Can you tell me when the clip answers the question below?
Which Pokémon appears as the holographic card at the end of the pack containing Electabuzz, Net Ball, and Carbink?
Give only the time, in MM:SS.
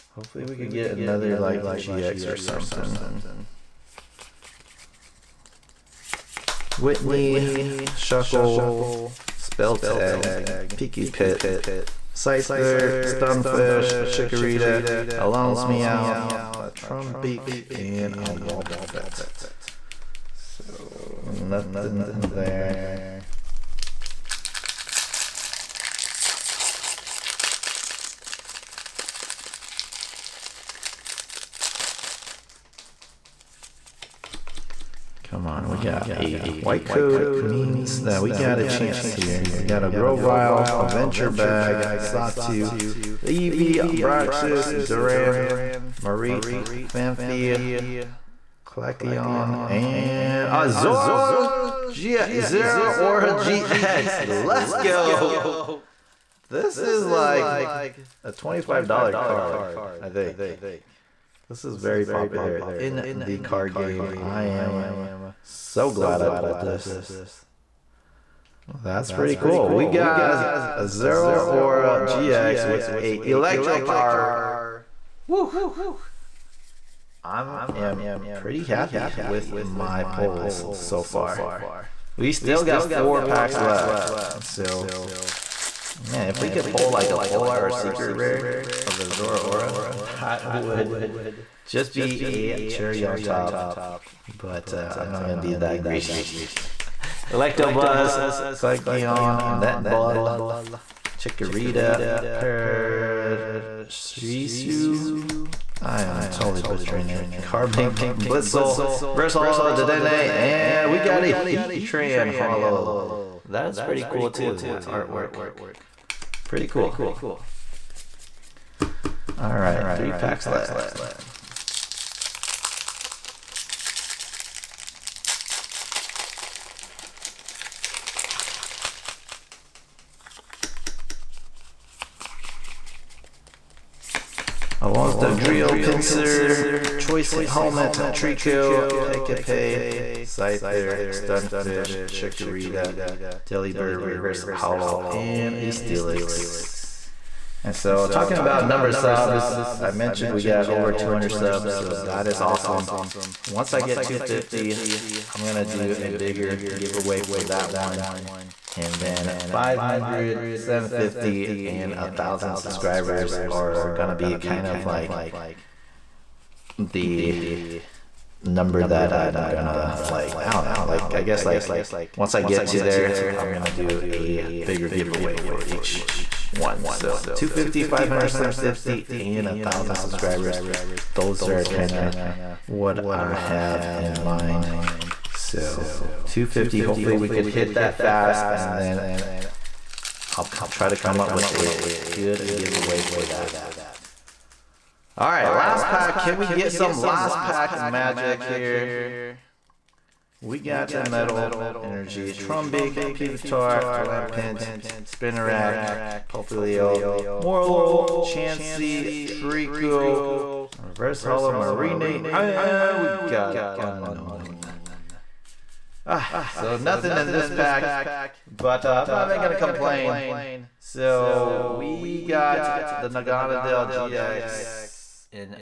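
01:51.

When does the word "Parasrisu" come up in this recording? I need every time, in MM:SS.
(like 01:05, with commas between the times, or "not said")
01:42.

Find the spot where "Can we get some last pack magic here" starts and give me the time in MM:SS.
03:16.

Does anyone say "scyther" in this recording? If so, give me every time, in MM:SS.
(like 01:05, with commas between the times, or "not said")
00:12, 02:20.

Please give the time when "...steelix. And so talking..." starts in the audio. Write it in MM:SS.
02:25.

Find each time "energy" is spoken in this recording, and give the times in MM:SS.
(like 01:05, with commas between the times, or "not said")
03:21.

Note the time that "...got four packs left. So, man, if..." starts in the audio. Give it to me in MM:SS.
01:22.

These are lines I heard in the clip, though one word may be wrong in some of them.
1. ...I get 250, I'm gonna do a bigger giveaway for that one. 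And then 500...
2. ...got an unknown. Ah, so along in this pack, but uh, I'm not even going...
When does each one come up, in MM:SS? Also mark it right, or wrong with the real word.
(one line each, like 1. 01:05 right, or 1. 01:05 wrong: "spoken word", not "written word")
1. 02:33 right
2. 03:33 wrong: "nothing", not "along".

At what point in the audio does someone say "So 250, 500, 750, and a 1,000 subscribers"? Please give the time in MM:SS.
02:56.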